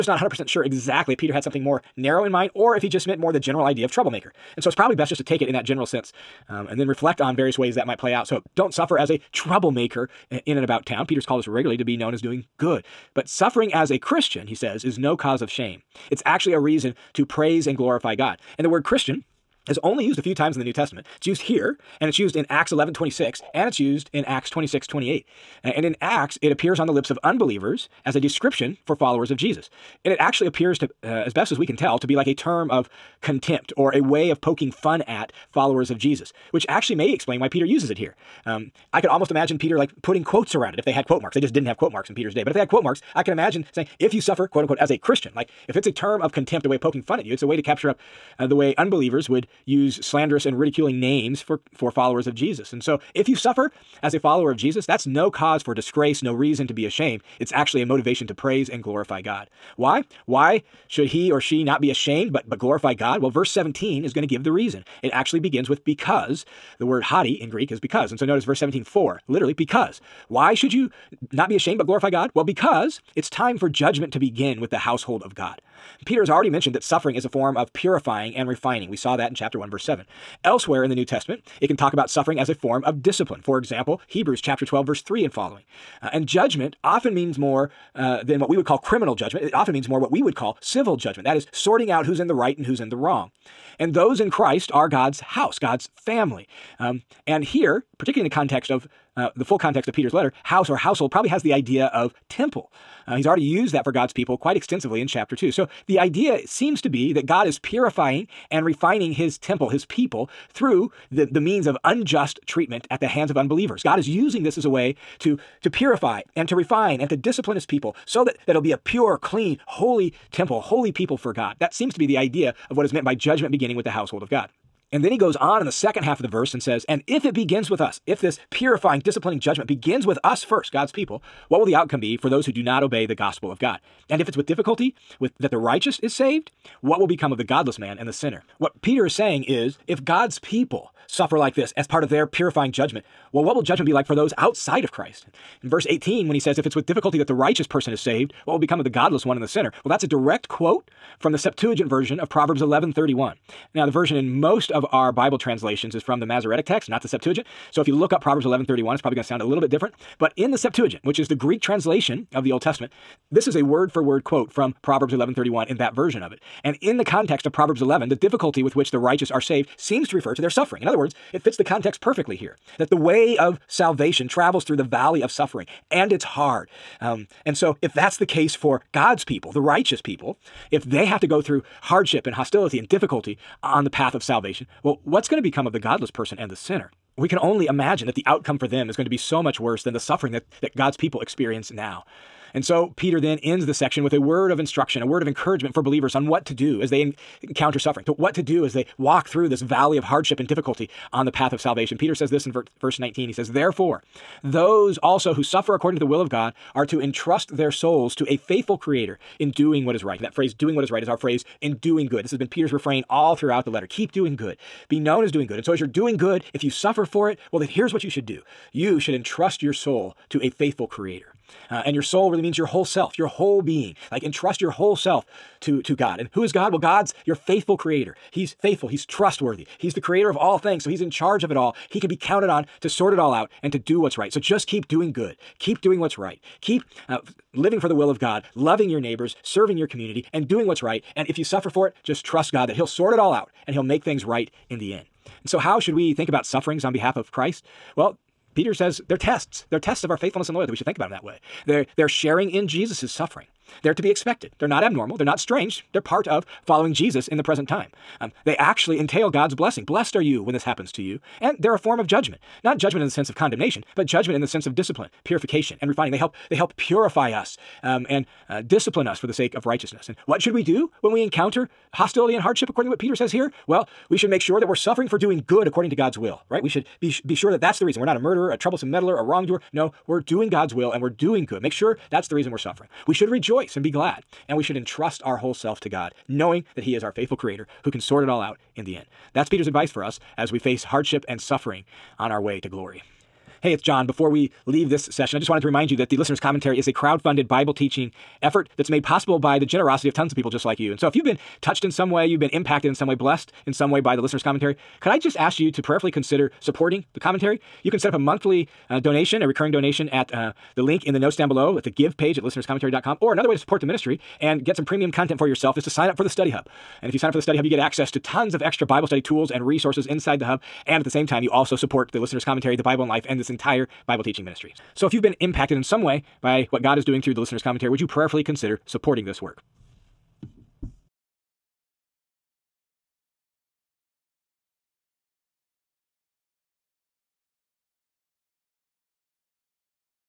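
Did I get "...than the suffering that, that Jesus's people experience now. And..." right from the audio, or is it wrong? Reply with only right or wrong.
wrong.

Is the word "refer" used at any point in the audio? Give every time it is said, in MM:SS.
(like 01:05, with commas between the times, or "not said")
02:50.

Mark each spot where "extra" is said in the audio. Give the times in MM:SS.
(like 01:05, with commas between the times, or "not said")
05:18.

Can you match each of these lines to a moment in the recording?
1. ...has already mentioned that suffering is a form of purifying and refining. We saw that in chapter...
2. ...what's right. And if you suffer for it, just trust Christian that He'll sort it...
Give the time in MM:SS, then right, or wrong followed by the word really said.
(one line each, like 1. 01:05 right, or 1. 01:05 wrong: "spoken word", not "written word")
1. 01:16 right
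2. 04:00 wrong: "God", not "Christian".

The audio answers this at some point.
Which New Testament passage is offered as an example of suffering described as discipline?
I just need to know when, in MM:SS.
01:24.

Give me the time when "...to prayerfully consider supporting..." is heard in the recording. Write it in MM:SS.
05:05.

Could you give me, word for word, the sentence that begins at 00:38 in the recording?
Um, I could almost imagine Peter like putting quotes around it if they had quote marks.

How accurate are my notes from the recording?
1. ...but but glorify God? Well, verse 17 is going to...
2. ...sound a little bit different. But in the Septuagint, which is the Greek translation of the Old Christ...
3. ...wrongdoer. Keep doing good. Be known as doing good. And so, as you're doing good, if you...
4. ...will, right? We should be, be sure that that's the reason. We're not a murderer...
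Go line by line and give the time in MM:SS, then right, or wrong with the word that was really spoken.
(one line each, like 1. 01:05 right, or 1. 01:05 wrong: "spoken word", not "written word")
1. 01:02 right
2. 02:39 wrong: "Testament", not "Christ"
3. 03:33 wrong: "letter", not "wrongdoer"
4. 04:36 right.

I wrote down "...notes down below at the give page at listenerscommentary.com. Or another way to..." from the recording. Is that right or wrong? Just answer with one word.
right.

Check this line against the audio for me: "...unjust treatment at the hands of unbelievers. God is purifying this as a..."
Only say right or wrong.
wrong.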